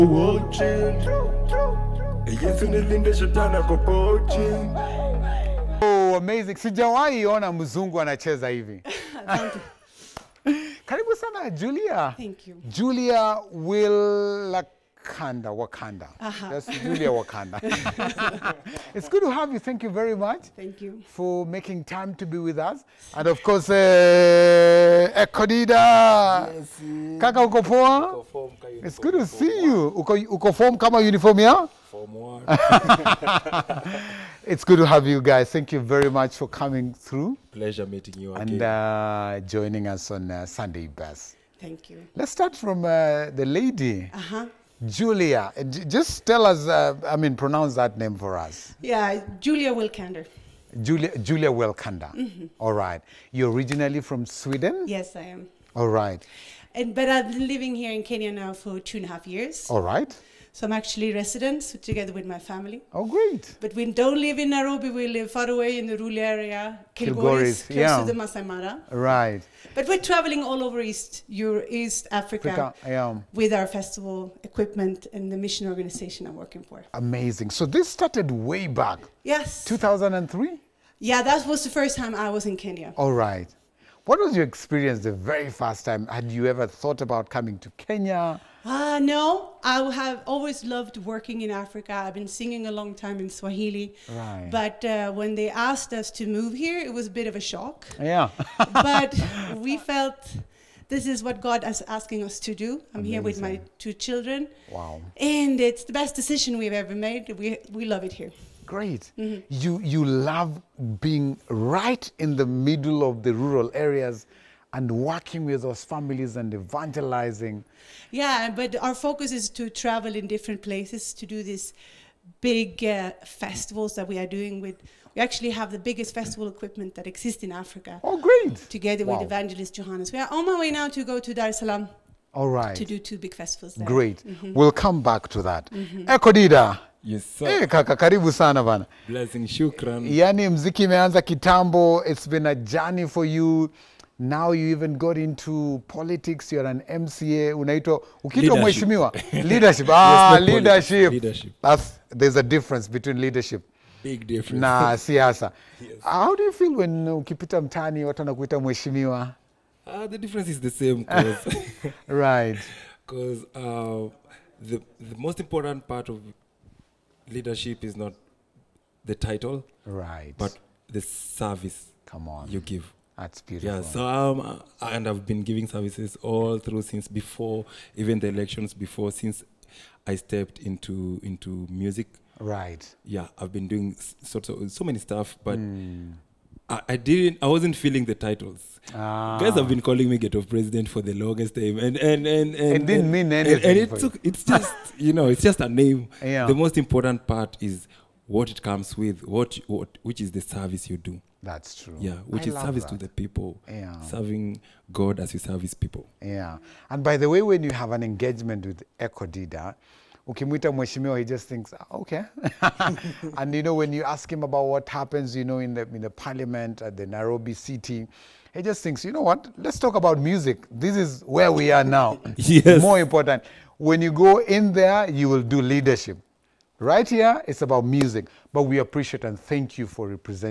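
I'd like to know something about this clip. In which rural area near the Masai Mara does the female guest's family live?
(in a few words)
Kilgoris.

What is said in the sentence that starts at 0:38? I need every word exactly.
And uh, joining us on uh, Sunday Bus.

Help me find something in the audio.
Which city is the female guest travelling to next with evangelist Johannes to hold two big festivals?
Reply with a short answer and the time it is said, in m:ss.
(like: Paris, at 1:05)
Dar es Salaam, at 2:11.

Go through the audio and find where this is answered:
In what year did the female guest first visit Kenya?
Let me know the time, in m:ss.
1:19.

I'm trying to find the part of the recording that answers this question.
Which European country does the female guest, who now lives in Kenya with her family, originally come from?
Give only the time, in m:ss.
0:54.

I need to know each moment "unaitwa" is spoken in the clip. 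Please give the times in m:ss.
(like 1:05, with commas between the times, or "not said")
2:27.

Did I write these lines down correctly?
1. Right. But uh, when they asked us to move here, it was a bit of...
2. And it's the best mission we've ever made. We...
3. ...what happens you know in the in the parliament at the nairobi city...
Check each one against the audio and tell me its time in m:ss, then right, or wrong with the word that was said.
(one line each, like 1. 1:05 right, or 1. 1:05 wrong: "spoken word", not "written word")
1. 1:34 right
2. 1:45 wrong: "decision", not "mission"
3. 3:34 right.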